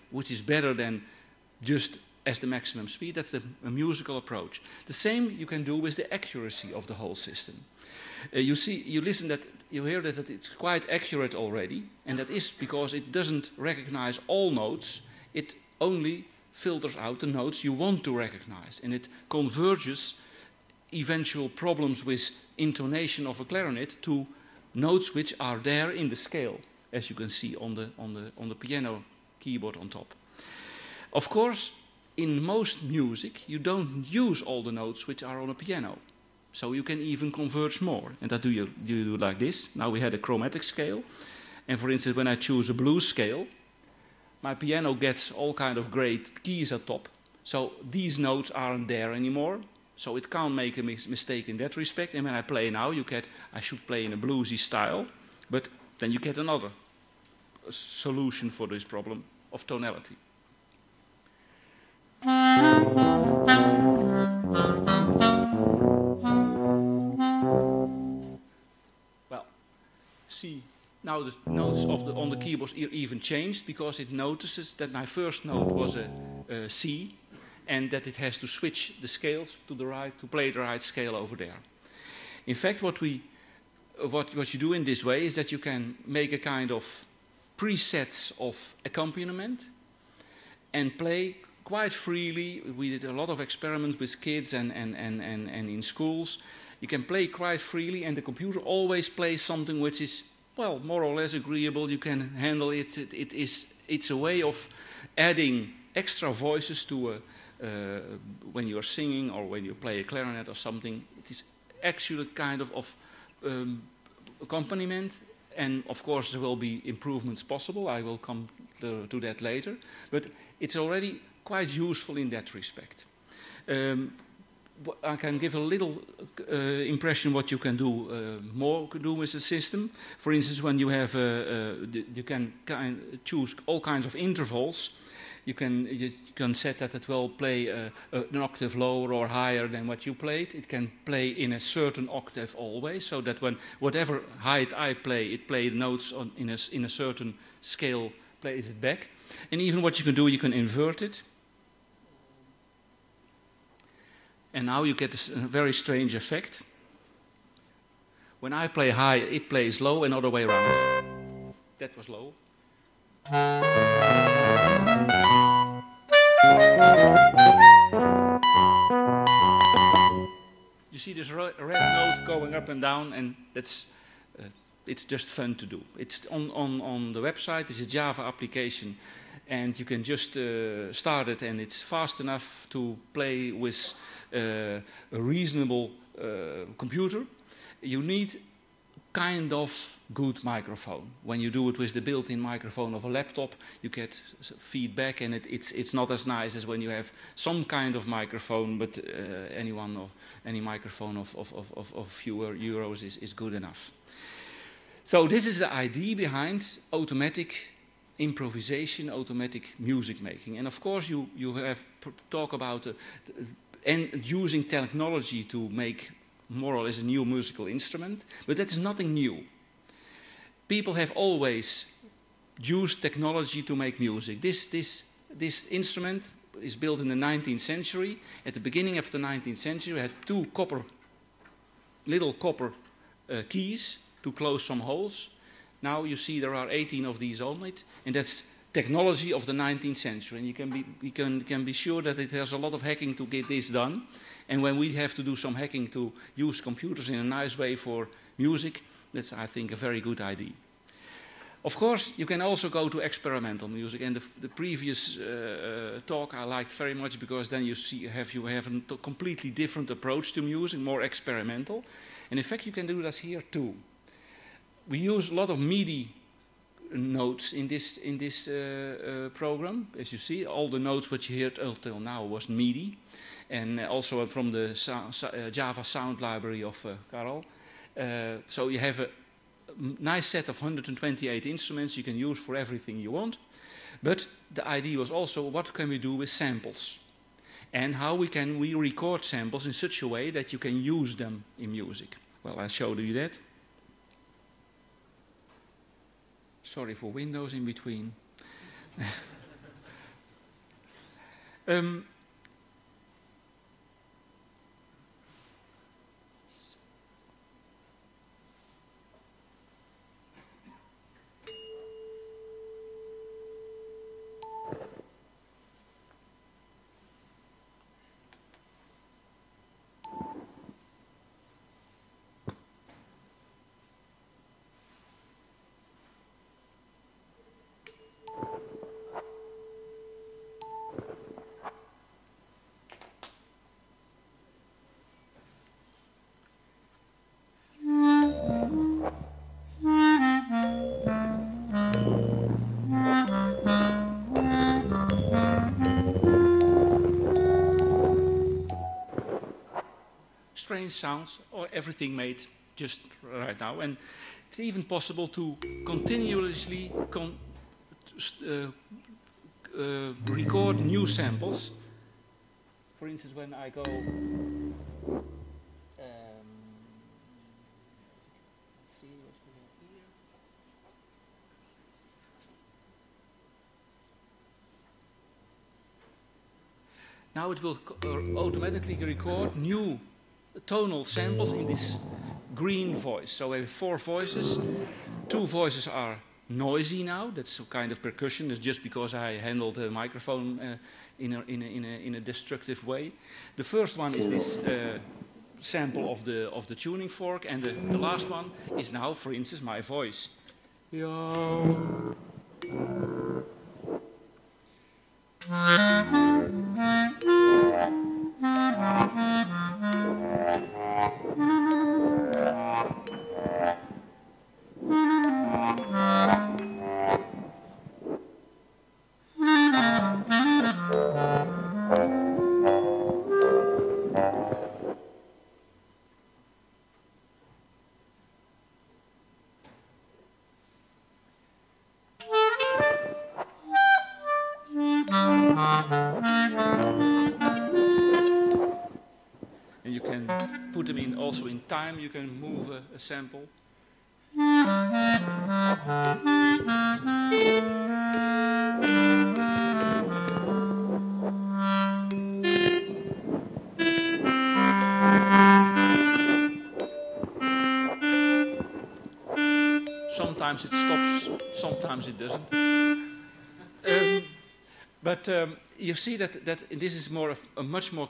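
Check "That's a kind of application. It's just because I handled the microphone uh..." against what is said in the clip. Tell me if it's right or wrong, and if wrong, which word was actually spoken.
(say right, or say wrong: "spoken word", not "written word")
wrong: "percussion", not "application".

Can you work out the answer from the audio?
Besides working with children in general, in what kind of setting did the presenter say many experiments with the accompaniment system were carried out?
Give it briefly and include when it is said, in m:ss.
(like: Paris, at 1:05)
Schools, at 1:35.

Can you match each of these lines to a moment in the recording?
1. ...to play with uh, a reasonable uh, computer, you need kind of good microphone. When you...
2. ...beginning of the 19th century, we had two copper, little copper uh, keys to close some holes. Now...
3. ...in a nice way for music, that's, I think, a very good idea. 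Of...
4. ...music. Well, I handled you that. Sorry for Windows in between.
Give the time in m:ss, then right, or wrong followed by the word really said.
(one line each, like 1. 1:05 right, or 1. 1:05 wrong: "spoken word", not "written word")
1. 3:02 right
2. 3:48 right
3. 4:07 right
4. 4:51 wrong: "showed", not "handled".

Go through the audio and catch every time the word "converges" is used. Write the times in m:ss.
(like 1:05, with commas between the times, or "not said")
0:19, 0:37.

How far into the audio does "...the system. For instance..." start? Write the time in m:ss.
2:09.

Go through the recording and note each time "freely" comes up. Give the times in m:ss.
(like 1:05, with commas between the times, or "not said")
1:31, 1:37.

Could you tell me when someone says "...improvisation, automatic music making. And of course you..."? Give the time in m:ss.
3:28.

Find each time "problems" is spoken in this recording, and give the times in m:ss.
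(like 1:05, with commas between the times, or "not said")
0:21, 0:58.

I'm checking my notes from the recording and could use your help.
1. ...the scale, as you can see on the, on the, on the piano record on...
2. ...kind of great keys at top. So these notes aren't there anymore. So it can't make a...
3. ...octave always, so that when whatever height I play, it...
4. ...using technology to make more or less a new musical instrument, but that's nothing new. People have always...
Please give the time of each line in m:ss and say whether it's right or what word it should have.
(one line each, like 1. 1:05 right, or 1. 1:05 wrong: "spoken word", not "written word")
1. 0:26 wrong: "keyboard", not "record"
2. 0:45 right
3. 2:22 right
4. 3:34 right.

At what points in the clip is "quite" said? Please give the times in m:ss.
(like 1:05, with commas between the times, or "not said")
0:10, 1:31, 1:37, 2:01.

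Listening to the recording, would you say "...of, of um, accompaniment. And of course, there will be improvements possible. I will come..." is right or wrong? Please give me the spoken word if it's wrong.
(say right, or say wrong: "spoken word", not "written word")
right.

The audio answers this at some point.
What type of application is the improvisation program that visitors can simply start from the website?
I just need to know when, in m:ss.
2:57.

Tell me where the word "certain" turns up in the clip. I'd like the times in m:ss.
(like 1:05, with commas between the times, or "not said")
2:21, 2:26.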